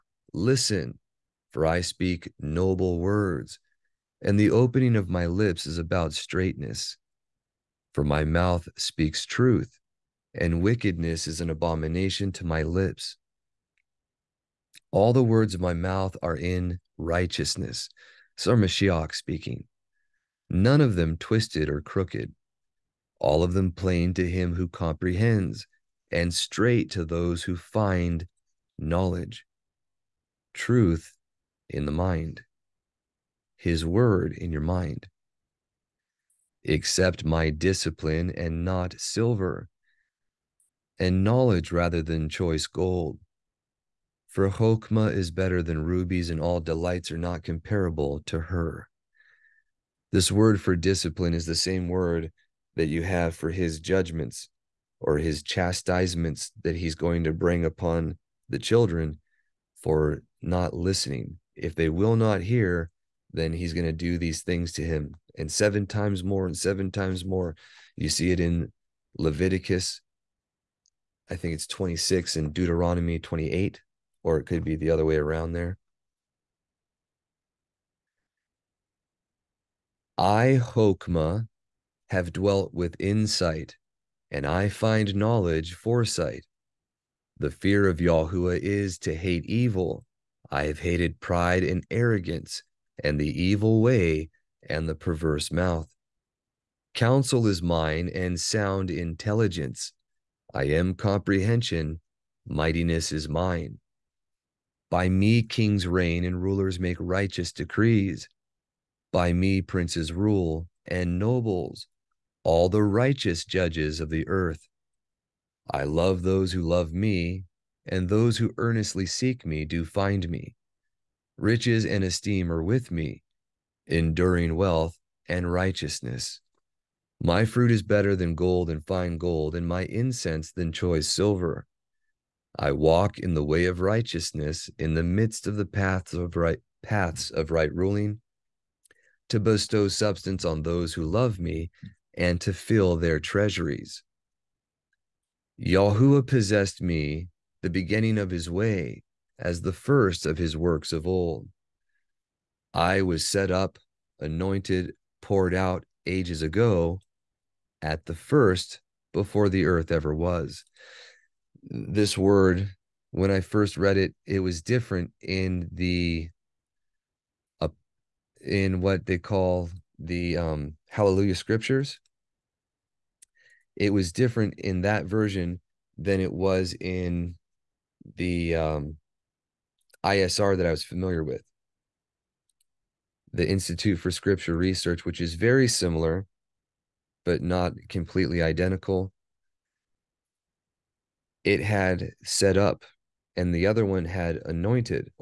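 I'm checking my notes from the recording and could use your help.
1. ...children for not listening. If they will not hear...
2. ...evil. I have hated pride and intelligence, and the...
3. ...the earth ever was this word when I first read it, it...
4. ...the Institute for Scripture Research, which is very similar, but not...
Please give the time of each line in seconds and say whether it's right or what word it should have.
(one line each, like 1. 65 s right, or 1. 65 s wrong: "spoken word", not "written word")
1. 58 s right
2. 89 s wrong: "arrogance", not "intelligence"
3. 159 s right
4. 183 s right.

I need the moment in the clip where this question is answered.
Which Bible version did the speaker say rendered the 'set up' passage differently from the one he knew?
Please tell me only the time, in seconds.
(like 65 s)
170 s.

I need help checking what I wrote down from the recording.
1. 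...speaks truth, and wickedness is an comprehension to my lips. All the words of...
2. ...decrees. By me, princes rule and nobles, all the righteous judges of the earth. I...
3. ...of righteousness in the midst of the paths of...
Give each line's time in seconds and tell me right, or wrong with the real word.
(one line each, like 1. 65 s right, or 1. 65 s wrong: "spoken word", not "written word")
1. 8 s wrong: "abomination", not "comprehension"
2. 107 s right
3. 133 s right.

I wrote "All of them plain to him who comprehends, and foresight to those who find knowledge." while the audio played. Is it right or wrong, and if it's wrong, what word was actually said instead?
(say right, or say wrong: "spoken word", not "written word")
wrong: "straight", not "foresight".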